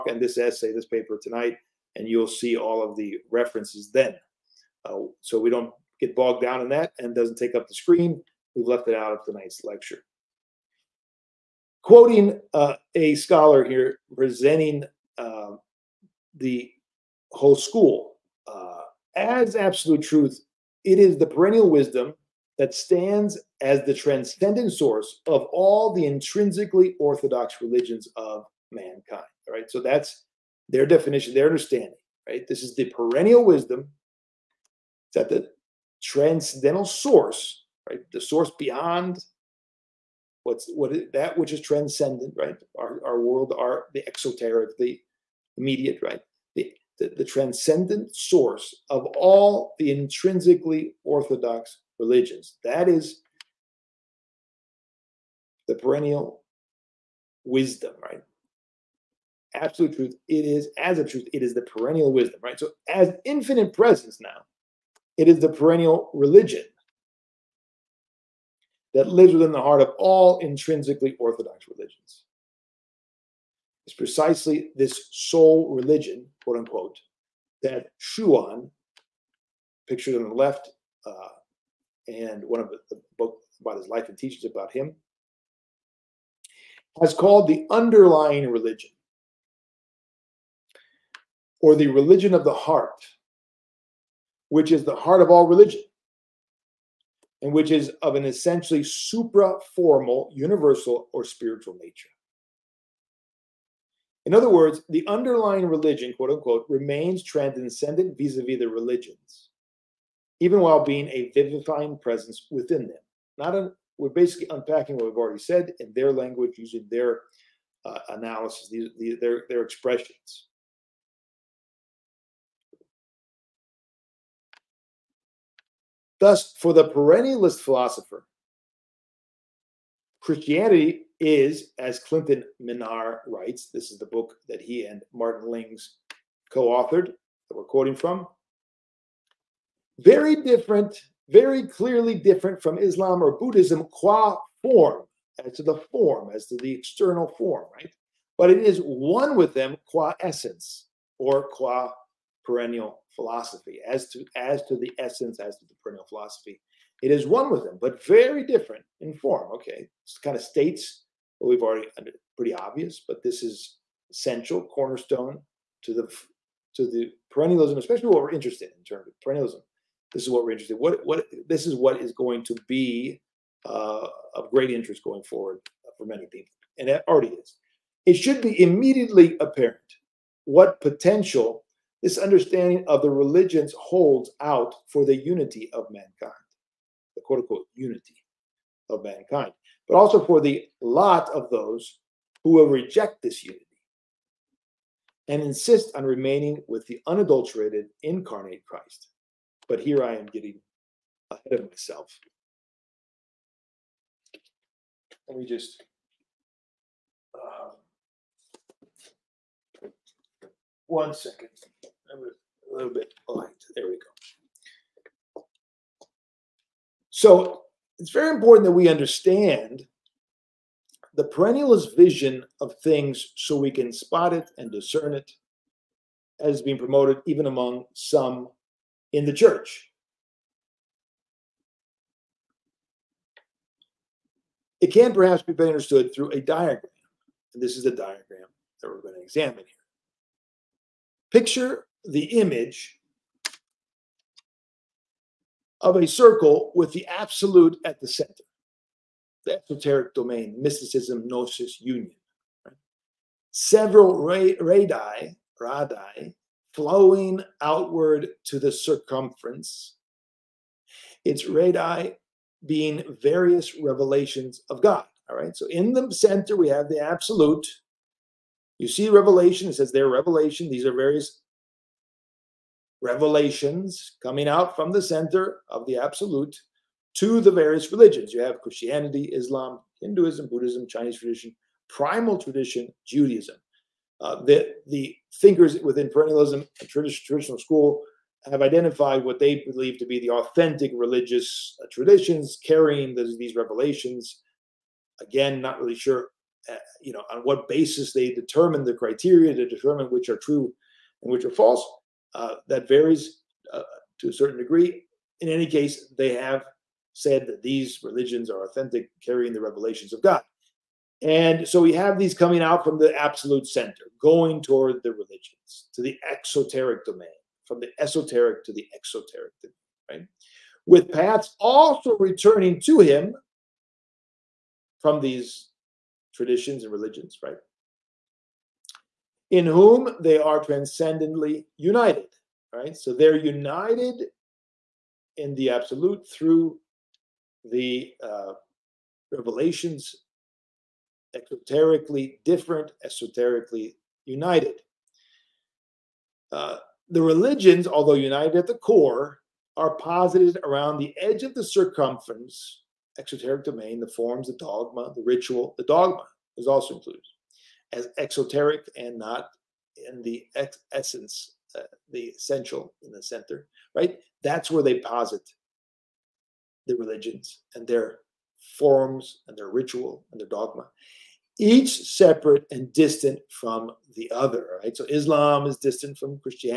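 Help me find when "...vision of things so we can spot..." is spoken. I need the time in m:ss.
3:41.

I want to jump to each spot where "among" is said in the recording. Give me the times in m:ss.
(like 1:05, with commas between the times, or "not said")
3:47.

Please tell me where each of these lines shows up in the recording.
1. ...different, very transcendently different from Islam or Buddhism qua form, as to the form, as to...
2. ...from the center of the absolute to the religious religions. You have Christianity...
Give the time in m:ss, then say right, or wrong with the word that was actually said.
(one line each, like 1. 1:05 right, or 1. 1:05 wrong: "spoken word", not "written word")
1. 2:20 wrong: "clearly", not "transcendently"
2. 4:34 wrong: "various", not "religious".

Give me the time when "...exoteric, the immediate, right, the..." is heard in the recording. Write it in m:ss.
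0:44.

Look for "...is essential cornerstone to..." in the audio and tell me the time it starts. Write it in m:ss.
2:43.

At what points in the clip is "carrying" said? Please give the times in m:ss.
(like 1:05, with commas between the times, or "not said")
4:52, 5:09.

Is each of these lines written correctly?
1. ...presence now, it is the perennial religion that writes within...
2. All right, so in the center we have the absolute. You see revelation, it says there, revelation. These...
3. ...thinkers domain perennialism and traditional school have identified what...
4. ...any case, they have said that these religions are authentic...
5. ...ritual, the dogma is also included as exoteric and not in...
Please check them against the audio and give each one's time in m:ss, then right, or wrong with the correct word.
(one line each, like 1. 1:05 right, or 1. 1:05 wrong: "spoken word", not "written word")
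1. 1:03 wrong: "lives", not "writes"
2. 4:25 right
3. 4:45 wrong: "within", not "domain"
4. 5:05 right
5. 5:55 right.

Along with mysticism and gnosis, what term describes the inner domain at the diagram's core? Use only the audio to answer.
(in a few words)
Union.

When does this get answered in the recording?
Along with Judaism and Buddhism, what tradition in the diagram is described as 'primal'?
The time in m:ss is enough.
4:41.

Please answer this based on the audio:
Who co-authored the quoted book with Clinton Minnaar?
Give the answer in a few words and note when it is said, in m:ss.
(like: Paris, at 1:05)
Martin Lings, at 2:15.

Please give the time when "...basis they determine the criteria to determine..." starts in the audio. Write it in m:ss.
4:57.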